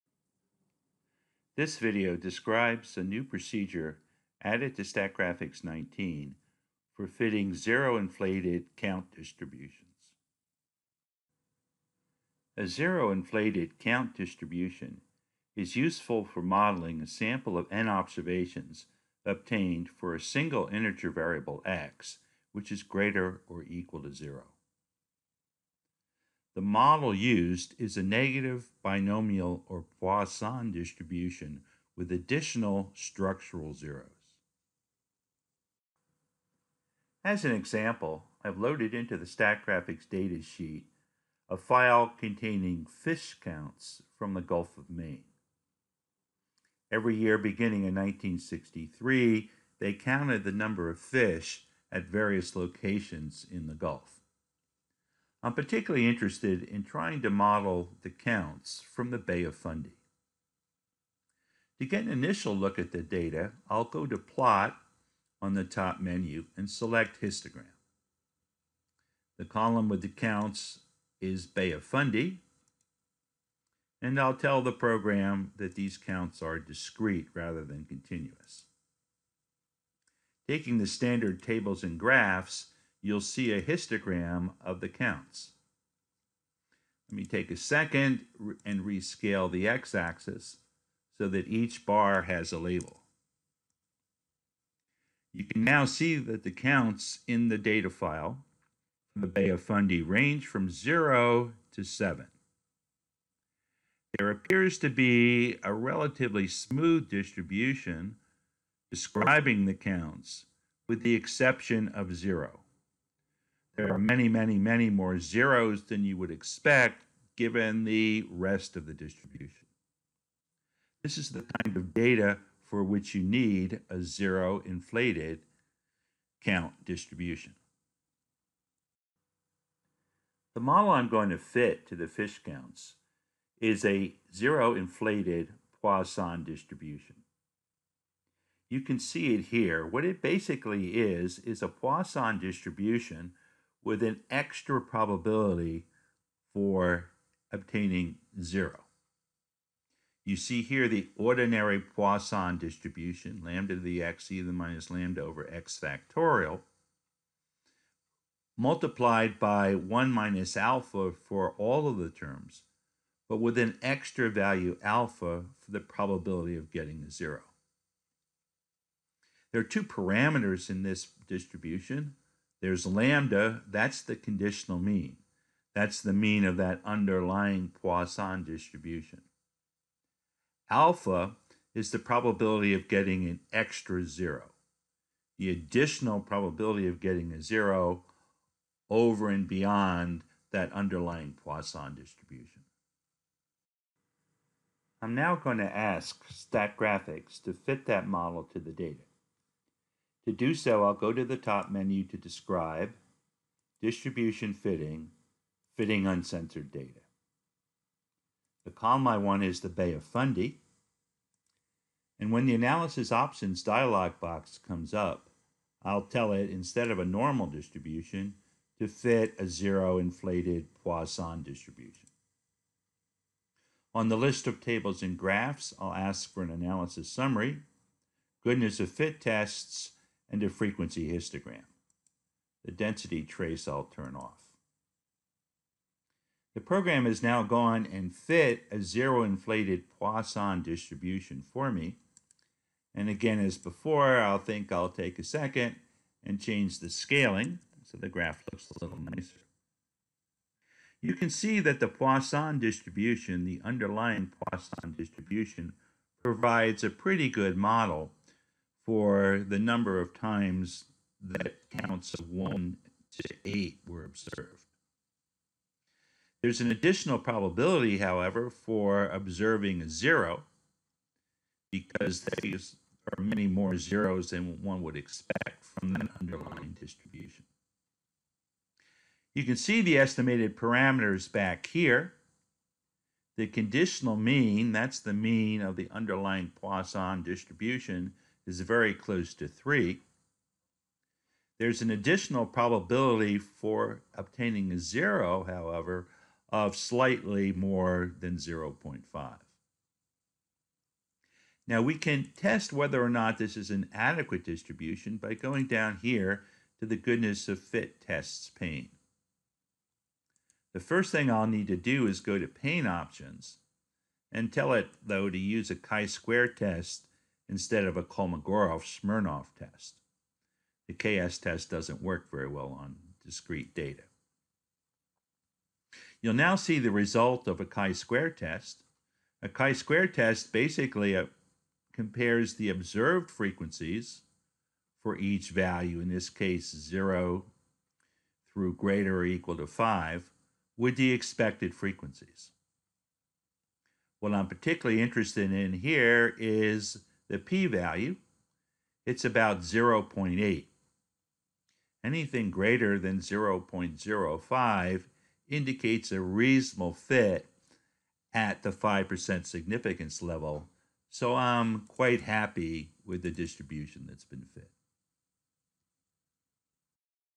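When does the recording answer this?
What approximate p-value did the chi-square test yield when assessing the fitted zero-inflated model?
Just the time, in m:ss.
5:49.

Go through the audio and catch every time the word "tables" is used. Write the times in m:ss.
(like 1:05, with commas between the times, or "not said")
1:21, 3:44.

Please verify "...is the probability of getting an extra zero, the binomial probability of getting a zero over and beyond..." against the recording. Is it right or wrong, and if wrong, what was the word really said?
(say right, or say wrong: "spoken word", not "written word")
wrong: "additional", not "binomial".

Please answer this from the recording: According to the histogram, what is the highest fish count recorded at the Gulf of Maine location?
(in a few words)
7.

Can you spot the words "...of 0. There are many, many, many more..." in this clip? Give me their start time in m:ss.
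1:51.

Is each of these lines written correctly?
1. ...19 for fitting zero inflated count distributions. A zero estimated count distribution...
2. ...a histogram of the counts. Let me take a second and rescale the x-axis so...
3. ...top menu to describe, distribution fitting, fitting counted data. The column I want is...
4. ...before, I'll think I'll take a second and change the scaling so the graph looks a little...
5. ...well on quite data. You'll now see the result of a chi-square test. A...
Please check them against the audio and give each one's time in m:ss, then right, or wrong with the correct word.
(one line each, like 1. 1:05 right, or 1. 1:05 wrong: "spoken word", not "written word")
1. 0:05 wrong: "inflated", not "estimated"
2. 1:23 right
3. 3:21 wrong: "uncensored", not "counted"
4. 4:03 right
5. 5:22 wrong: "discrete", not "quite".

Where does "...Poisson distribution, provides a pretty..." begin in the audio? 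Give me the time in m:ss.
4:14.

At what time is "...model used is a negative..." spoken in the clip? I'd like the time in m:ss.
0:26.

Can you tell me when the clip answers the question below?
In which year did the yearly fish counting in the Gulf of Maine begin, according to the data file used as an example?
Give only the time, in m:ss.
0:47.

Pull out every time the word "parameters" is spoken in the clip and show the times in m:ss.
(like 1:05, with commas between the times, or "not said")
2:49, 4:40.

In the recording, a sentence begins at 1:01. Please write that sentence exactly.
To get an initial look at the data, I'll go to Plot on the top menu and select Histogram.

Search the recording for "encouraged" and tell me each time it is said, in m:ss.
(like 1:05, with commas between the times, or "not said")
not said.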